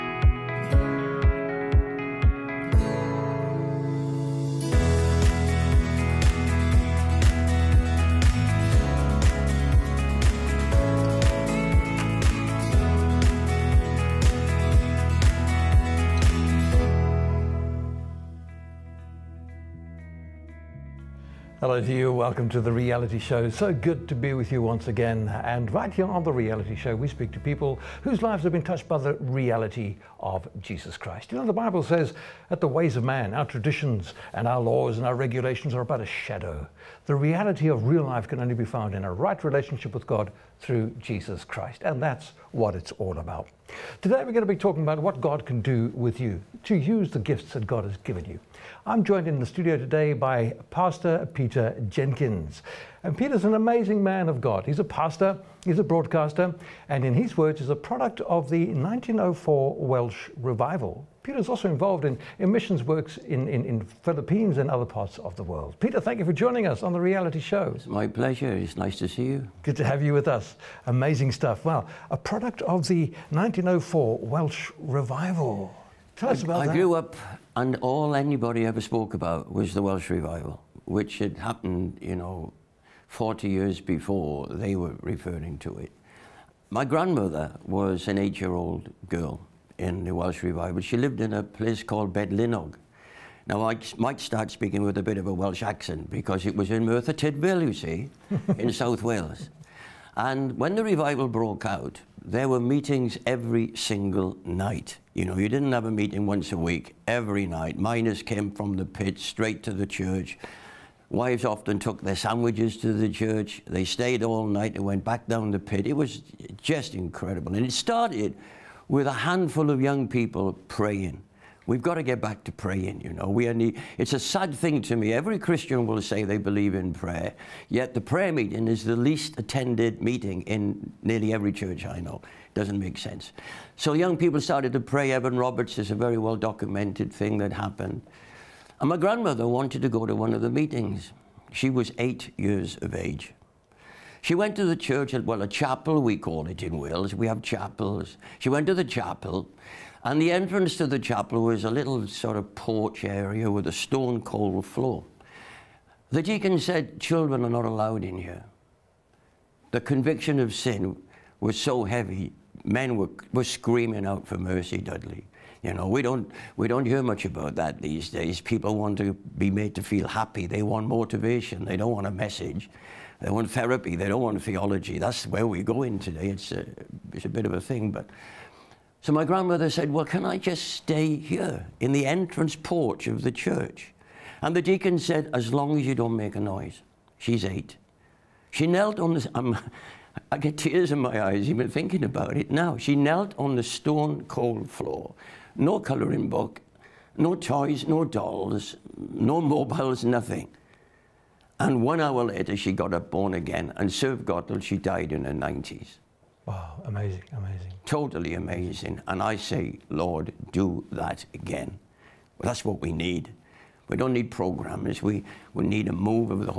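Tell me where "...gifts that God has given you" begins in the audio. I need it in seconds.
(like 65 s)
47 s.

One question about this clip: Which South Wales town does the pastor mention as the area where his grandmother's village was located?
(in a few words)
Merthyr Tydfil.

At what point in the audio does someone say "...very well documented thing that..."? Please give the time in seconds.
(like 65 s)
135 s.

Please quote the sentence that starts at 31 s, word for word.
You know, the Bible says that the ways of man, our traditions, and our laws and our regulations are but a shadow.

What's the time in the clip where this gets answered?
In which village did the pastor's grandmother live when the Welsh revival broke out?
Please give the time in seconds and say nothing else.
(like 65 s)
92 s.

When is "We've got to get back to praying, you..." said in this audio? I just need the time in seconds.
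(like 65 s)
121 s.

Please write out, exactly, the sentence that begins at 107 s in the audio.
Miners came from the pit straight to the church.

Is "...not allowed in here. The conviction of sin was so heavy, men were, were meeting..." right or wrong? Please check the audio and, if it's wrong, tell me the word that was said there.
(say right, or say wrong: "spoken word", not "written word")
wrong: "screaming", not "meeting".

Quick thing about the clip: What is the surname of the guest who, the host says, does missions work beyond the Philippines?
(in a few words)
Jenkins.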